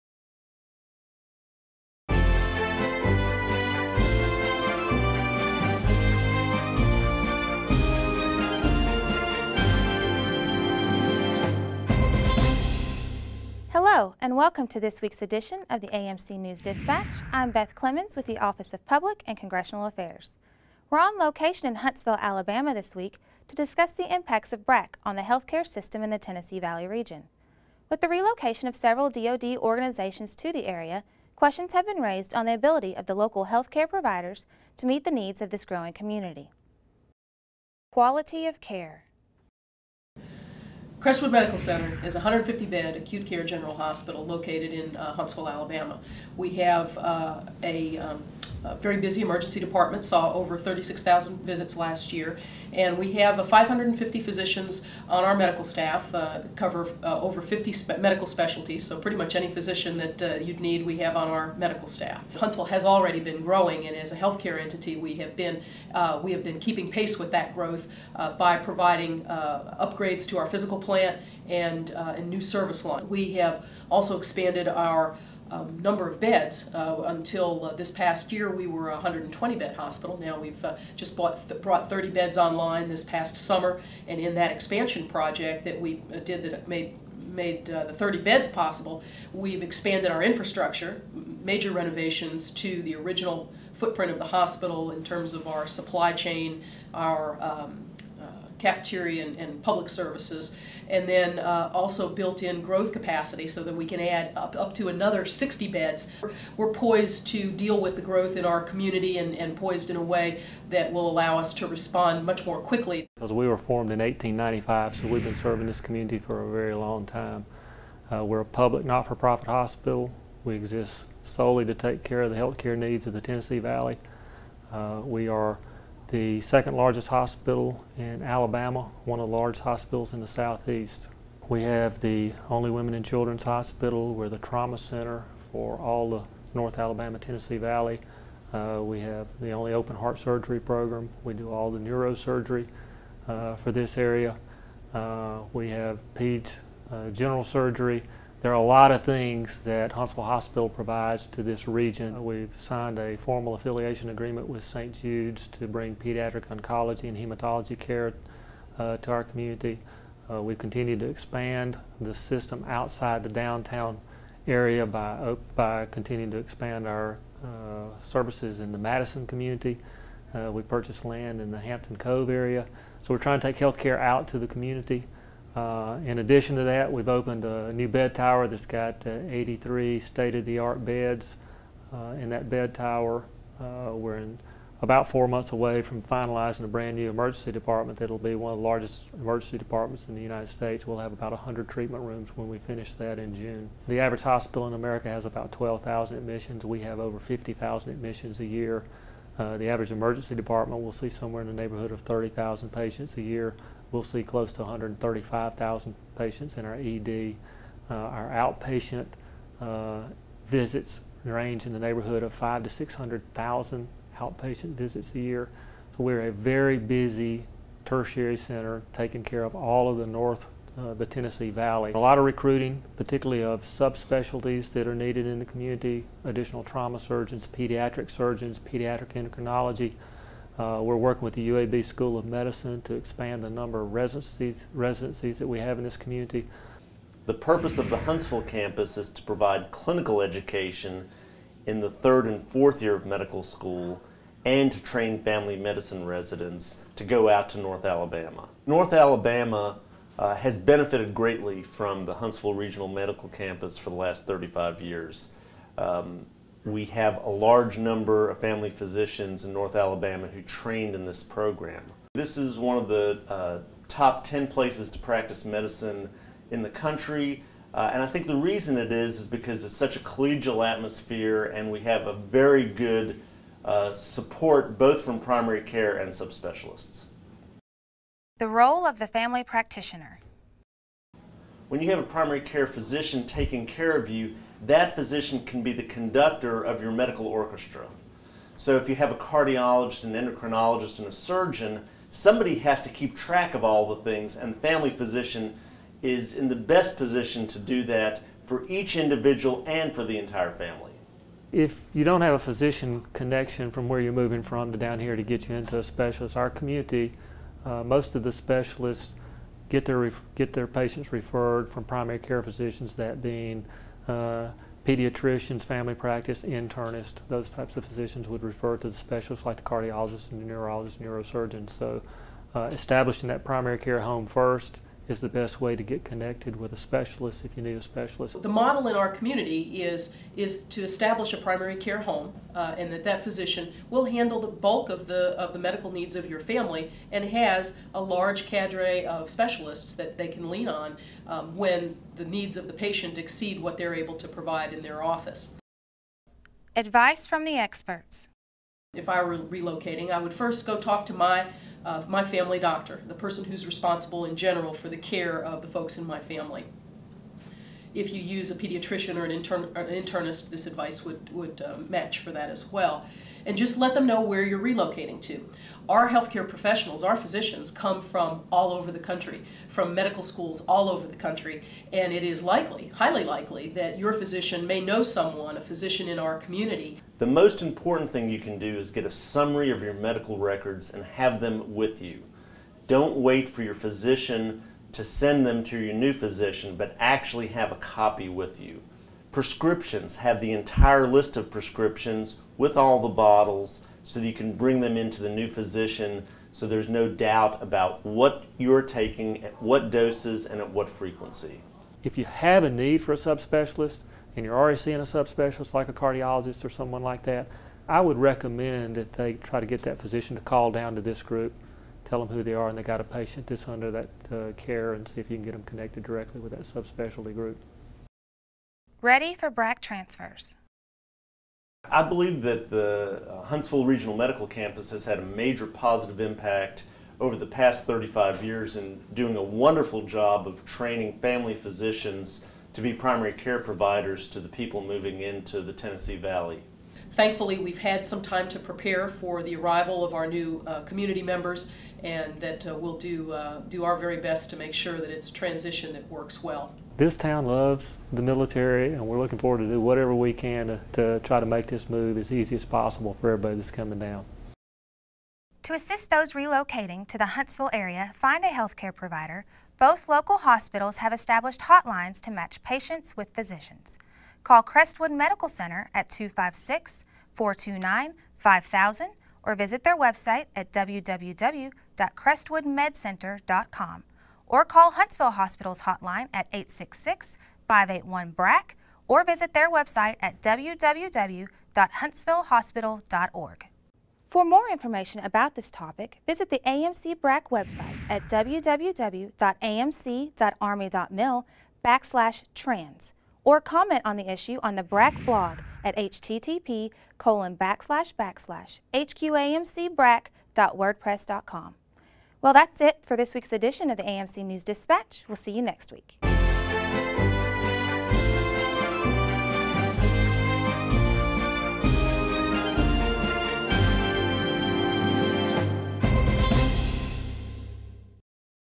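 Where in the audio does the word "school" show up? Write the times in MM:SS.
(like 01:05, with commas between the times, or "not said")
03:51, 04:03, 06:10.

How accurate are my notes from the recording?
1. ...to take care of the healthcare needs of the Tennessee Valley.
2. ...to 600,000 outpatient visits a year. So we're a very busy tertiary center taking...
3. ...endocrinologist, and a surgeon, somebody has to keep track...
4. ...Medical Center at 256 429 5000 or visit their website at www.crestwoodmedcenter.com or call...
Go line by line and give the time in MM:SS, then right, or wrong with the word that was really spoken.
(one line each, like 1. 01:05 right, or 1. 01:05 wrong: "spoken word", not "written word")
1. 02:01 right
2. 03:32 right
3. 04:50 right
4. 07:45 right.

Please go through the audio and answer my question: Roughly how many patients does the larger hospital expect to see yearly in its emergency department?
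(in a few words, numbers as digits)
135,000.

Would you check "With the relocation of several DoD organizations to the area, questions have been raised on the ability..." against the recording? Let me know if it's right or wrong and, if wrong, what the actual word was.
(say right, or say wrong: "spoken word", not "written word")
right.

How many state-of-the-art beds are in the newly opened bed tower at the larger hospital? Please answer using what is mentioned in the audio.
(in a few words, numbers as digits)
83.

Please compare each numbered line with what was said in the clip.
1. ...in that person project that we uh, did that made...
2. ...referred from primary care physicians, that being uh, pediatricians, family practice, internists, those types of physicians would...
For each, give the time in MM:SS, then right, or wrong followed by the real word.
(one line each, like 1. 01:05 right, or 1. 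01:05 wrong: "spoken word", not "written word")
1. 01:24 wrong: "expansion", not "person"
2. 05:11 right.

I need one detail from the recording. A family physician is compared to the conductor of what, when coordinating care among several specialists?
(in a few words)
medical orchestra.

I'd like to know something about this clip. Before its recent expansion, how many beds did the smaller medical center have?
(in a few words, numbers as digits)
120.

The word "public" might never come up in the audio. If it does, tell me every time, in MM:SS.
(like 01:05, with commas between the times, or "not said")
00:18, 01:39, 01:58.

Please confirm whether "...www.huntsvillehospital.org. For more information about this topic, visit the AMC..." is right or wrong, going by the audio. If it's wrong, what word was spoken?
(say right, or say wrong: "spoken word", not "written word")
right.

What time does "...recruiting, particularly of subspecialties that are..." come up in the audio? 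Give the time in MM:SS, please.
03:42.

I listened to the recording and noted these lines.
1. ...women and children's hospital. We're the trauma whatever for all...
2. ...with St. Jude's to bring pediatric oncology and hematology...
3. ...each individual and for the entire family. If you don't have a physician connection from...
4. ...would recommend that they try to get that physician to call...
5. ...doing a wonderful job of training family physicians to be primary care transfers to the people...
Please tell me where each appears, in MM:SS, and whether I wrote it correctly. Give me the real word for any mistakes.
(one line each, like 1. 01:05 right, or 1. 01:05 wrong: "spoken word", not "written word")
1. 02:12 wrong: "center", not "whatever"
2. 02:34 right
3. 04:58 right
4. 06:48 right
5. 07:09 wrong: "providers", not "transfers".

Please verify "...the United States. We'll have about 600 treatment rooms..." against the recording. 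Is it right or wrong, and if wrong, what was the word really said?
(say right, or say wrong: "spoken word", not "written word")
wrong: "100", not "600".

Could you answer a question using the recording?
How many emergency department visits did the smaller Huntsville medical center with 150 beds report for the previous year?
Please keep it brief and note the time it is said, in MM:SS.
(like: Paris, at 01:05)
36,000, at 00:50.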